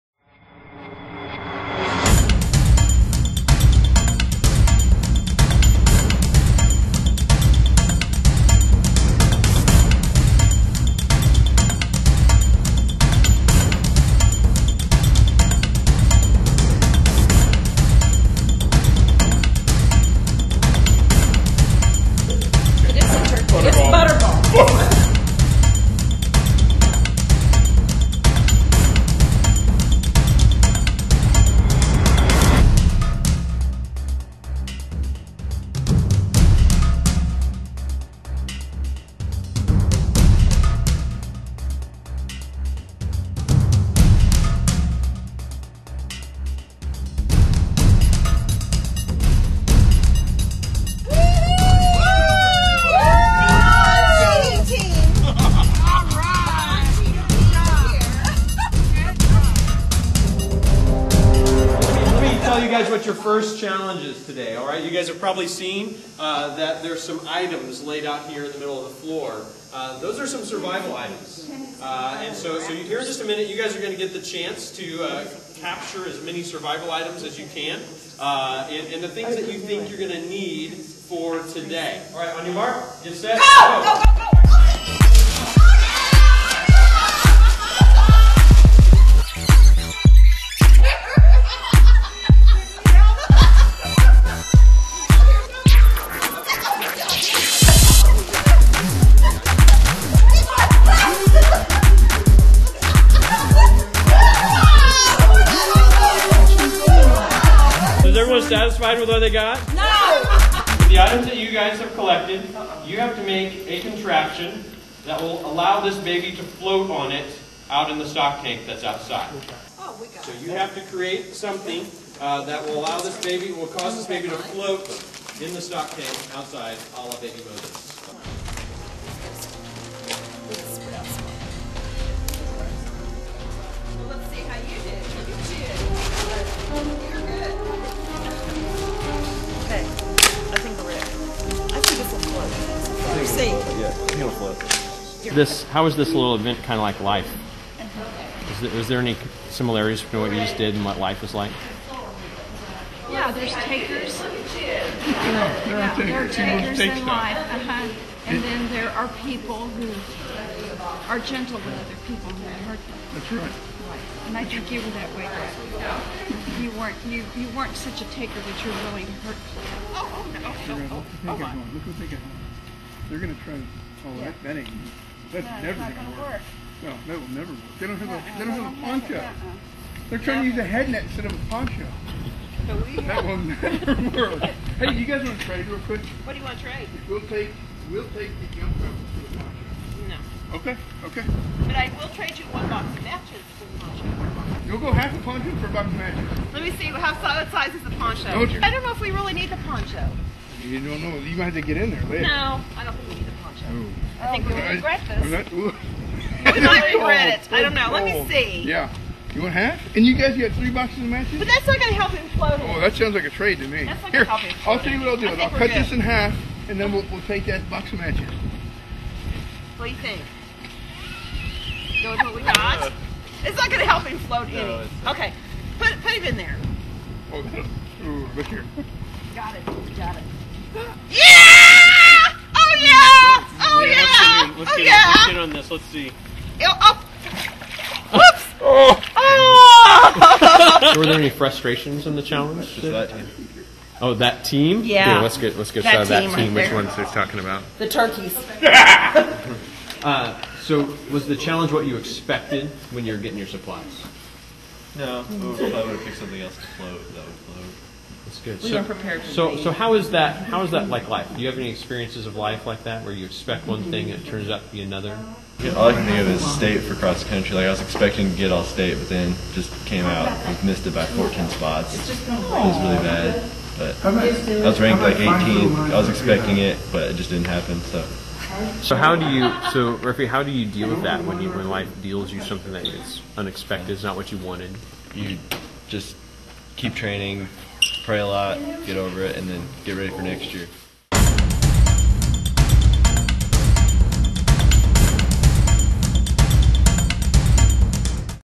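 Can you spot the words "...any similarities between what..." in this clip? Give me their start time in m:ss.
2:28.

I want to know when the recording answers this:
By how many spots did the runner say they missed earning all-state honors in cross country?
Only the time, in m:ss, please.
4:31.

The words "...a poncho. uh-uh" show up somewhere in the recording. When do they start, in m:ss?
2:58.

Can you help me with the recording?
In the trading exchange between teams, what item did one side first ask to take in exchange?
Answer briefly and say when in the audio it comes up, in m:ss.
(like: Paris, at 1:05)
Jump rope, at 3:08.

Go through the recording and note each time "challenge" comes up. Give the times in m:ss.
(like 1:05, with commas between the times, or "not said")
1:03, 4:02, 4:11.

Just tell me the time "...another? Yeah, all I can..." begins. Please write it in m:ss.
4:24.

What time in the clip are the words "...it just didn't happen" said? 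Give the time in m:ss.
4:37.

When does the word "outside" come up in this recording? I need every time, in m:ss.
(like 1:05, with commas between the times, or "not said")
1:58, 2:06.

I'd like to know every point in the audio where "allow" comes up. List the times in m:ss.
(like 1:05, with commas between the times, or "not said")
1:55, 2:02.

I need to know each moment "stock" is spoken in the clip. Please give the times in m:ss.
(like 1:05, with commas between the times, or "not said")
1:58, 2:05.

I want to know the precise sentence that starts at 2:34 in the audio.
Yeah, there are takers, there are takers in life.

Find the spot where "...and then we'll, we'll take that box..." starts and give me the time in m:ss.
3:36.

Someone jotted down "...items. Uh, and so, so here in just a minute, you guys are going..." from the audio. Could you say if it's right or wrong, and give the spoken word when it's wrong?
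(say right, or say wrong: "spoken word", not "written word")
right.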